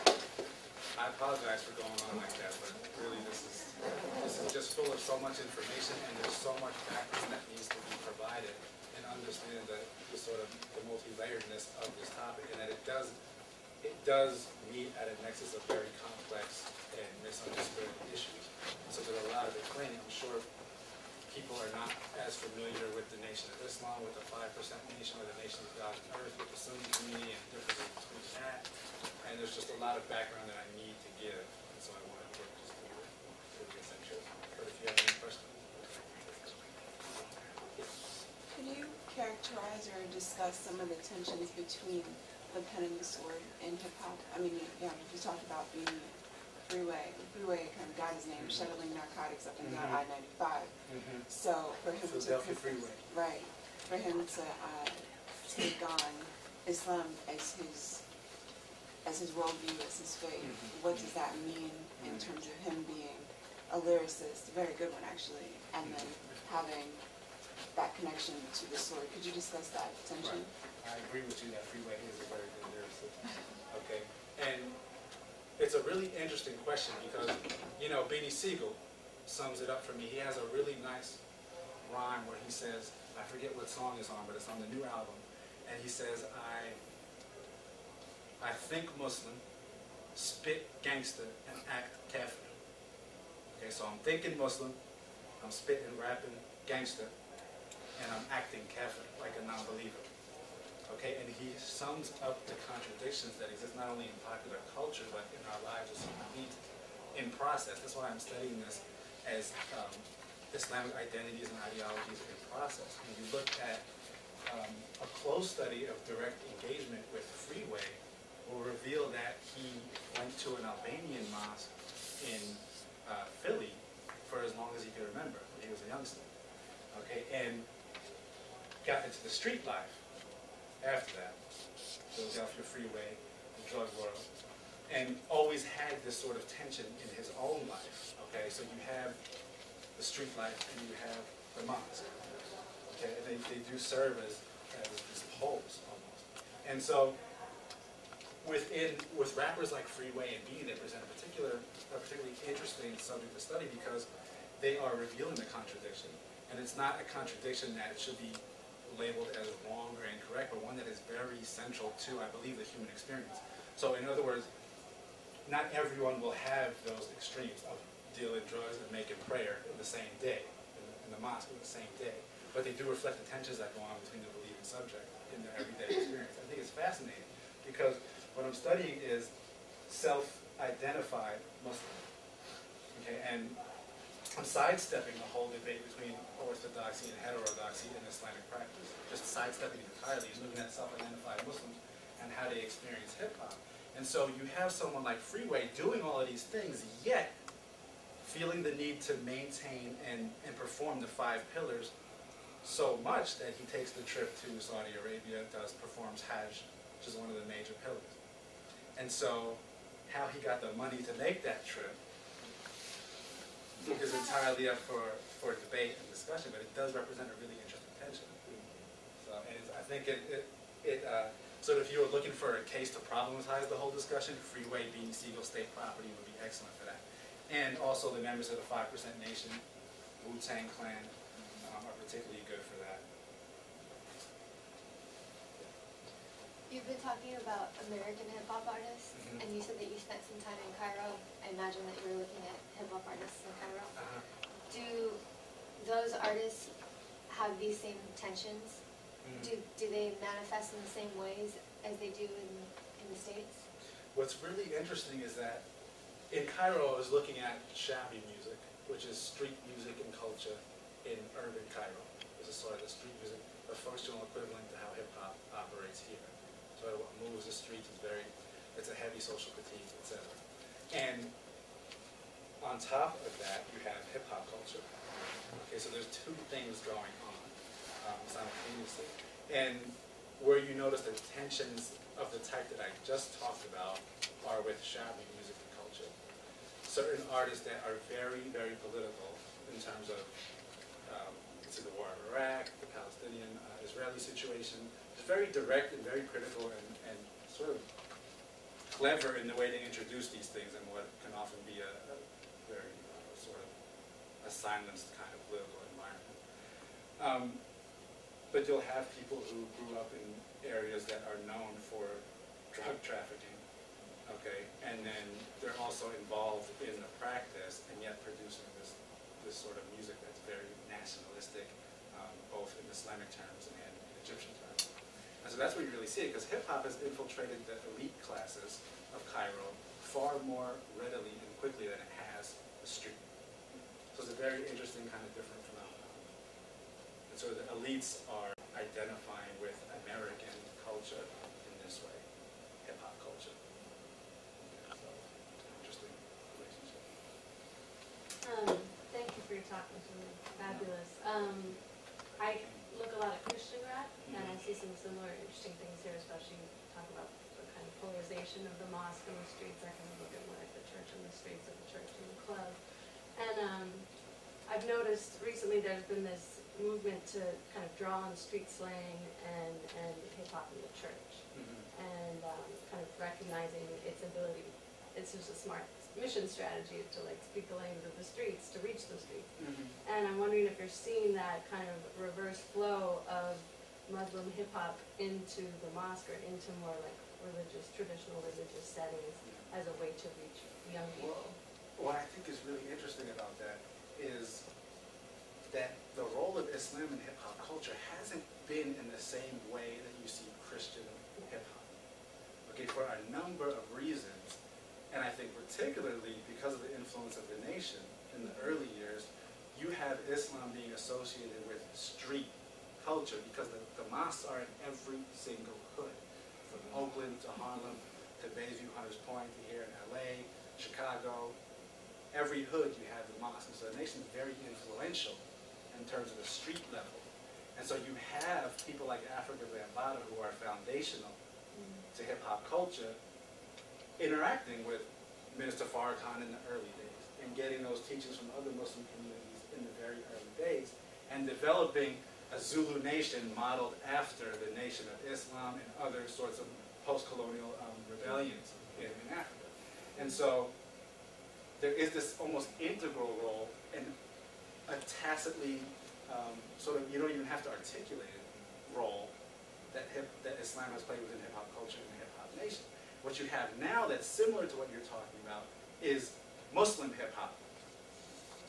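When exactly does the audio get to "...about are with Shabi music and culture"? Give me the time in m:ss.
4:43.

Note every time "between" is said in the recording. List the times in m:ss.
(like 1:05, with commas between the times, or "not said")
0:27, 0:41, 2:54, 3:05.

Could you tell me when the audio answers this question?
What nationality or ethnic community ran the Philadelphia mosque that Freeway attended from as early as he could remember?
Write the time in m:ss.
2:00.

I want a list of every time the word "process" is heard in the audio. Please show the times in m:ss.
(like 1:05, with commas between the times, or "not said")
1:47, 1:52.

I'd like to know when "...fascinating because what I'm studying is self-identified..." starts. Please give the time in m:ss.
2:56.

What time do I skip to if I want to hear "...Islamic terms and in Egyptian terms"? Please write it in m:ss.
5:22.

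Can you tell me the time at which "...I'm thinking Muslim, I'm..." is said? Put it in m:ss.
1:33.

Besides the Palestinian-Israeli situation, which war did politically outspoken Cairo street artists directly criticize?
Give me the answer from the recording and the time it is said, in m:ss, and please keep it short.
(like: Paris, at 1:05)
The war in Iraq, at 4:52.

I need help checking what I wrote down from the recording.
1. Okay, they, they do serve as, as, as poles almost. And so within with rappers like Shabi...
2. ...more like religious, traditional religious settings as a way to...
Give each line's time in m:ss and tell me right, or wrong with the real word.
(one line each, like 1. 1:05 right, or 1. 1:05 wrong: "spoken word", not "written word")
1. 2:22 wrong: "Freeway", not "Shabi"
2. 6:26 right.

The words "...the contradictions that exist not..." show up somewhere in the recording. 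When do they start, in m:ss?
1:42.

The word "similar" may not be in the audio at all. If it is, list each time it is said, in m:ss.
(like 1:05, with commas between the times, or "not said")
5:54, 7:44.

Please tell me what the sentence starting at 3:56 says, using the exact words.
You've been talking about American hip hop artists, mm -hmm.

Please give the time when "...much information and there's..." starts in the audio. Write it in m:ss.
0:05.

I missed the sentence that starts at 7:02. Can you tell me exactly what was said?
Every hood you have the mosque.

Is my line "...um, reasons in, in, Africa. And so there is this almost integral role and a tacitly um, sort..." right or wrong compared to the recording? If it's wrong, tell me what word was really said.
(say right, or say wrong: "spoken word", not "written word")
wrong: "rebellions", not "reasons".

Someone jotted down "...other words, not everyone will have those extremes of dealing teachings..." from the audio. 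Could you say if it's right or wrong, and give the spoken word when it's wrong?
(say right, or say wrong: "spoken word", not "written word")
wrong: "drugs", not "teachings".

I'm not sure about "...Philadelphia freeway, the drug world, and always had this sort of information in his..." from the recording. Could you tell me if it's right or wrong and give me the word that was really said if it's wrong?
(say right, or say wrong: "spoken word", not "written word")
wrong: "tension", not "information".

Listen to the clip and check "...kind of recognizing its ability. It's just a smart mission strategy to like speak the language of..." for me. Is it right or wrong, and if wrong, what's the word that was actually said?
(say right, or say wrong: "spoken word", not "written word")
right.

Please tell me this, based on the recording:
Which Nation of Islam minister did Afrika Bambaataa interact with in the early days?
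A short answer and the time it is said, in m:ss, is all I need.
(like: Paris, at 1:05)
Minister Farrakhan, at 7:15.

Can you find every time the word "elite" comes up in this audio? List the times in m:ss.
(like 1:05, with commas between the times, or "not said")
5:27, 5:37.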